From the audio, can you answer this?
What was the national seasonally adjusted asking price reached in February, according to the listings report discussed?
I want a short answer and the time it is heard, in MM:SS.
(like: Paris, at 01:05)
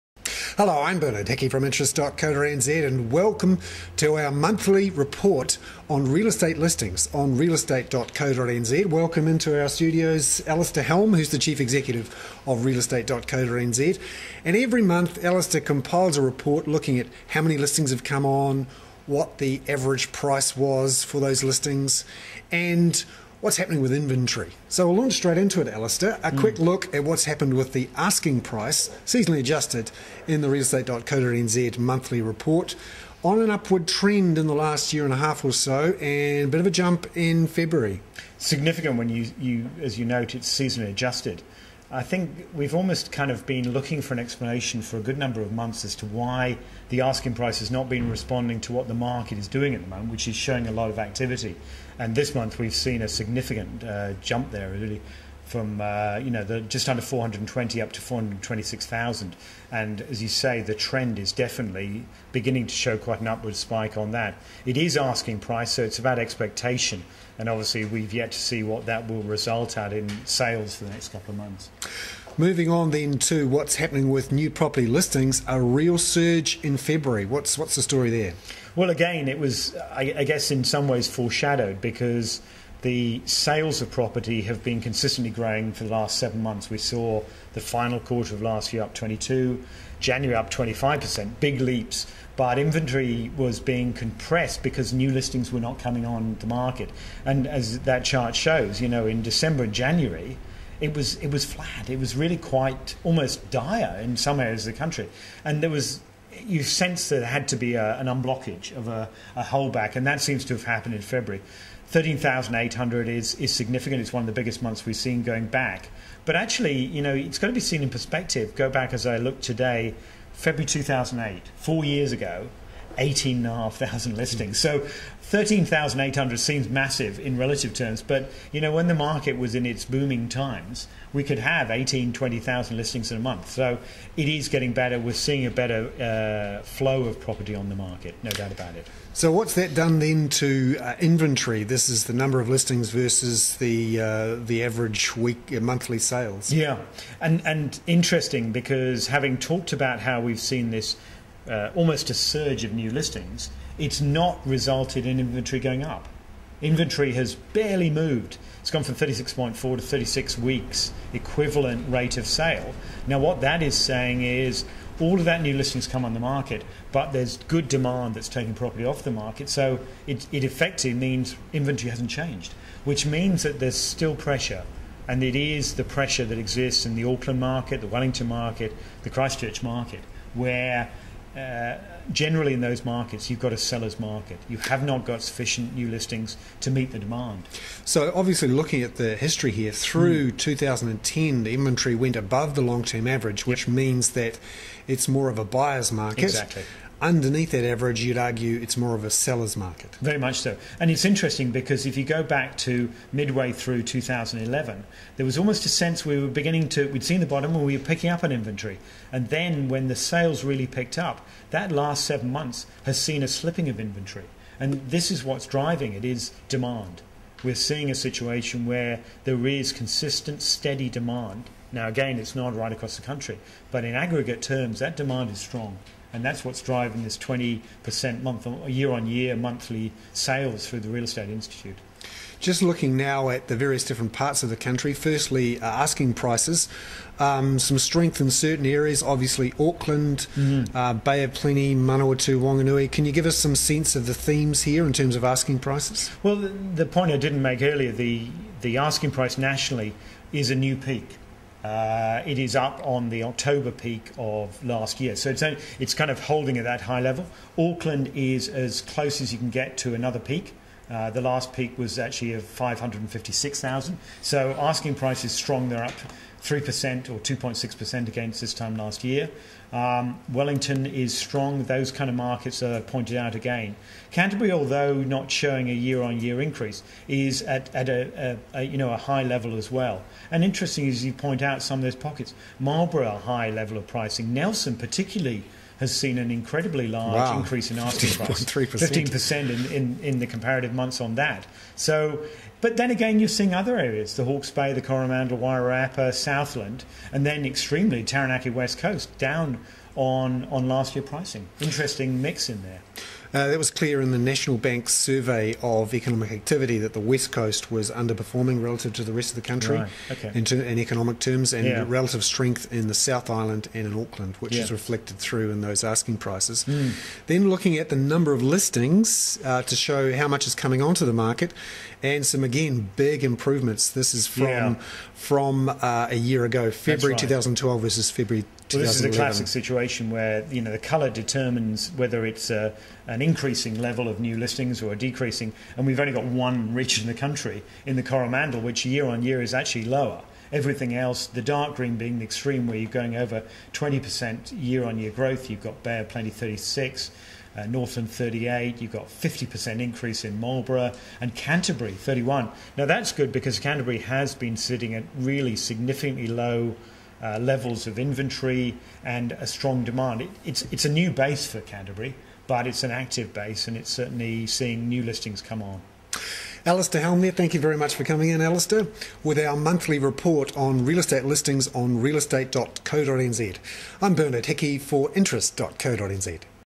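$426,000, at 00:58.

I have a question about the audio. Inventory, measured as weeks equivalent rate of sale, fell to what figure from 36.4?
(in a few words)
36 weeks.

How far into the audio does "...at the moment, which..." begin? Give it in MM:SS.
00:49.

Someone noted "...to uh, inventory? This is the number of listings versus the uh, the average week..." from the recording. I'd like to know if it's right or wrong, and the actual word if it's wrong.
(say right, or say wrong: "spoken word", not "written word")
right.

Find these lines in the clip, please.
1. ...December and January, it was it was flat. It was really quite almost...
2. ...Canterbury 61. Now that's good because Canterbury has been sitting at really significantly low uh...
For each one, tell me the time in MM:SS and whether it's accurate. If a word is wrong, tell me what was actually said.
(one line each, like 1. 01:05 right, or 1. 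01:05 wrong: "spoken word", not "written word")
1. 01:39 right
2. 05:51 wrong: "31", not "61".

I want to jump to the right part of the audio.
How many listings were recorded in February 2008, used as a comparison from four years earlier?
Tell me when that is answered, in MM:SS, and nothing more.
02:02.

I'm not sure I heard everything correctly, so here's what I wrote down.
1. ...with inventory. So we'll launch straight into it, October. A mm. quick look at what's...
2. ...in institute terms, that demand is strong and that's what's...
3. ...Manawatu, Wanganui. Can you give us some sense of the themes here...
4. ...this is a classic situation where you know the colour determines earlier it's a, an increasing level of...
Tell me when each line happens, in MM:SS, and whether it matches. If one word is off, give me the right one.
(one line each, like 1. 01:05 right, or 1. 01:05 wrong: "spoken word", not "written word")
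1. 00:23 wrong: "Alistair", not "October"
2. 03:43 wrong: "aggregate", not "institute"
3. 04:01 right
4. 05:28 wrong: "whether", not "earlier".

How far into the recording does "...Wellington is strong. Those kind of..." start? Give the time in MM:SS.
04:30.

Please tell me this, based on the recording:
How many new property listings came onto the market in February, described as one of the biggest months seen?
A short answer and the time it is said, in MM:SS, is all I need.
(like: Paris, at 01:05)
13,800, at 01:51.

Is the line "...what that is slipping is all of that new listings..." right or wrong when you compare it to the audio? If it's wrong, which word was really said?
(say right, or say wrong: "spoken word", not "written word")
wrong: "saying", not "slipping".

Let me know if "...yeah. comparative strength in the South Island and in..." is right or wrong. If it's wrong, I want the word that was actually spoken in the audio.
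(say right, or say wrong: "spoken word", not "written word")
wrong: "relative", not "comparative".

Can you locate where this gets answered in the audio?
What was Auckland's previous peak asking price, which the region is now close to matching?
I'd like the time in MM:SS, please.
04:22.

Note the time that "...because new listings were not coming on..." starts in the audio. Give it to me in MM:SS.
01:34.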